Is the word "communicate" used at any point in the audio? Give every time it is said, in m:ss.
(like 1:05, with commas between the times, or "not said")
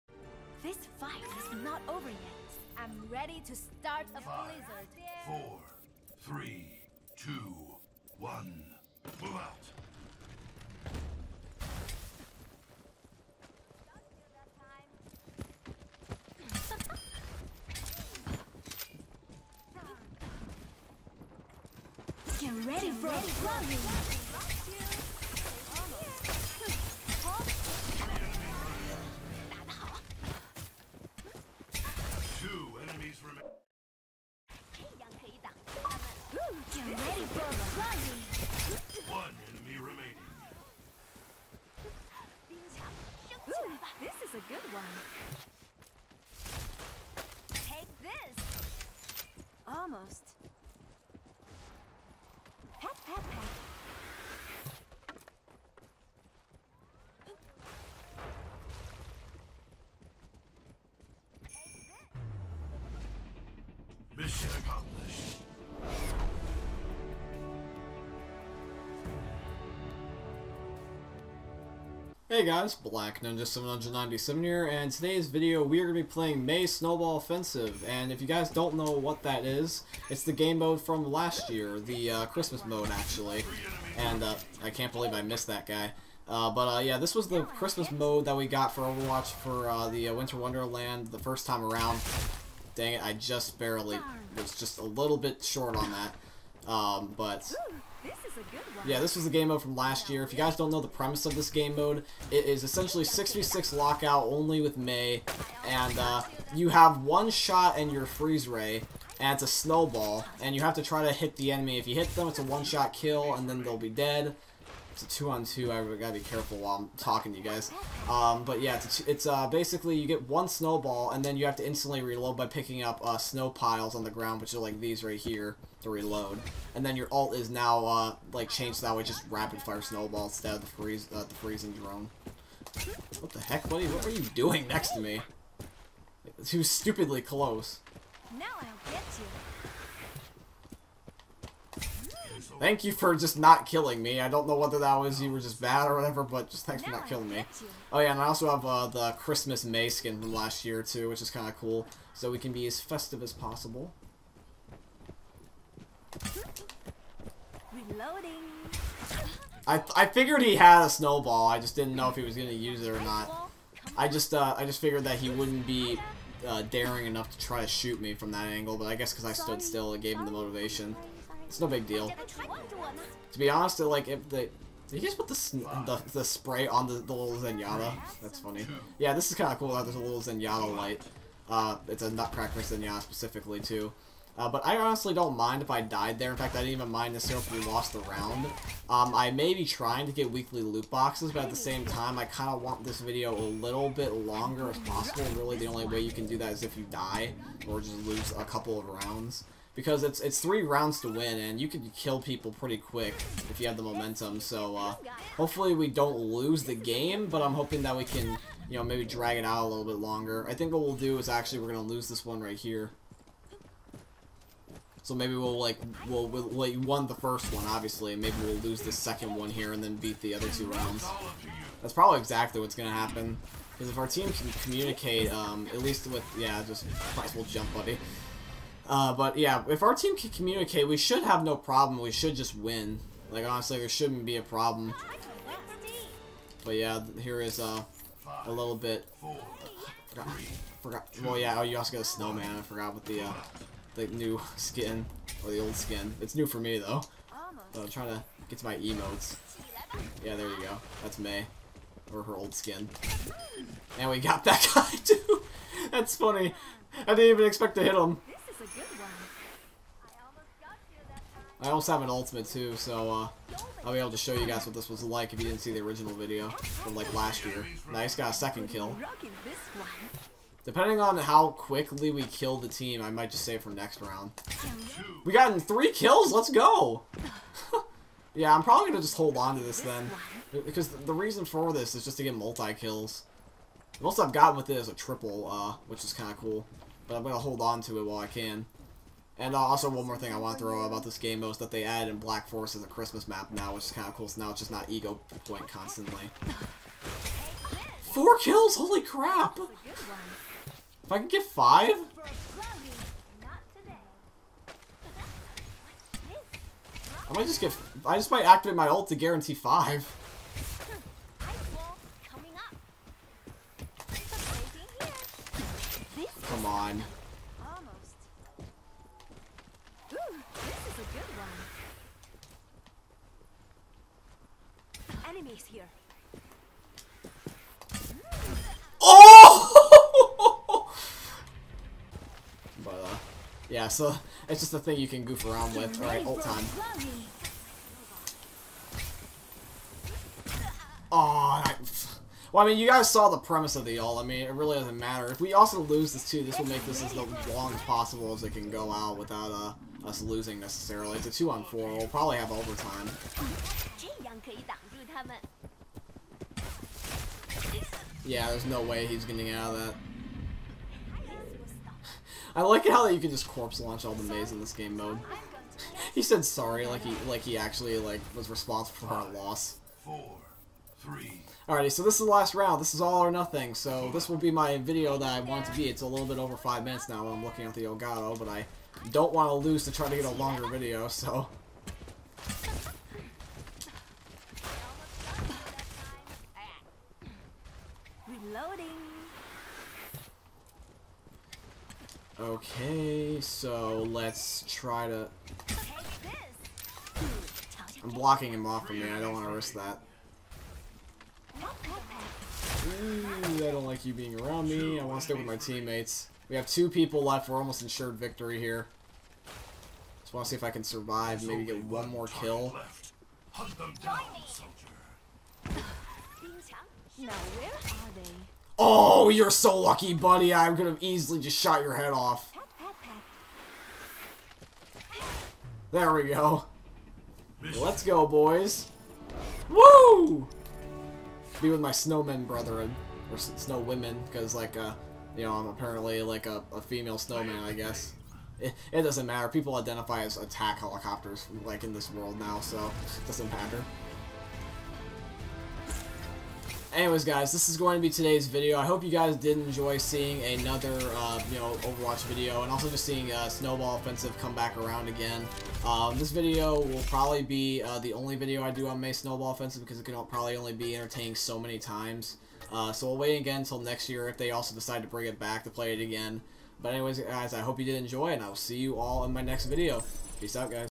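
3:44, 3:50.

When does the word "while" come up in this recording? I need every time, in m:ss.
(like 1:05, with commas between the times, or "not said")
1:56, 4:48.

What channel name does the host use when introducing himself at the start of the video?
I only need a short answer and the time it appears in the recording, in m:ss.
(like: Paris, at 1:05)
Black Ninja 797, at 1:12.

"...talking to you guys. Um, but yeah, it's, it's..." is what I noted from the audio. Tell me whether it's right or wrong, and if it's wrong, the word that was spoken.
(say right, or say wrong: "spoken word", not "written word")
right.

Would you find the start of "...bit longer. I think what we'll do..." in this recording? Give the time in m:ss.
3:29.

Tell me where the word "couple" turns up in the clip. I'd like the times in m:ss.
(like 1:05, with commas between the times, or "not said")
3:18.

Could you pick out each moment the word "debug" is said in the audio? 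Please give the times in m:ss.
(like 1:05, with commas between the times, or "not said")
not said.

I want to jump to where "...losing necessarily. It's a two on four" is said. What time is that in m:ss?
5:50.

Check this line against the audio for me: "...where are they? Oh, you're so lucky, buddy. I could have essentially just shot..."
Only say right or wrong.
wrong.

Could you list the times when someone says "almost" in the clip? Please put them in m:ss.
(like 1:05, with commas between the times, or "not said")
0:49, 6:47.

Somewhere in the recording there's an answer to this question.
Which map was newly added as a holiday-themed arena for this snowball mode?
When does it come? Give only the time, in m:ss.
4:52.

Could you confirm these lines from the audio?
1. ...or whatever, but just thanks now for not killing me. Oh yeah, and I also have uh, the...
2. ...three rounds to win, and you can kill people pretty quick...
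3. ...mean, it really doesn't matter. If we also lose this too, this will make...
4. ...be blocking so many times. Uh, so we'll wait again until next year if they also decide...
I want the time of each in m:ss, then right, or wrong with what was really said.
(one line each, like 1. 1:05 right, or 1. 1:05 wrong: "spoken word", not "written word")
1. 2:25 right
2. 3:20 right
3. 5:44 right
4. 7:40 wrong: "entertaining", not "blocking".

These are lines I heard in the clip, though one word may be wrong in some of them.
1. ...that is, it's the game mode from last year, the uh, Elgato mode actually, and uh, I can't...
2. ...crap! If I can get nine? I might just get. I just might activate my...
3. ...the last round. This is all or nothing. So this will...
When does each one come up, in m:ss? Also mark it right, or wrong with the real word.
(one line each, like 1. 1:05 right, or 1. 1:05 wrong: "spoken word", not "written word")
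1. 1:19 wrong: "Christmas", not "Elgato"
2. 4:59 wrong: "five", not "nine"
3. 6:12 right.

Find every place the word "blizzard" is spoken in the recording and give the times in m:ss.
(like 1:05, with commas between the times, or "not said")
0:05.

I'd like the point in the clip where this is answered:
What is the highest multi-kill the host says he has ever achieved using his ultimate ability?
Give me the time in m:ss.
4:44.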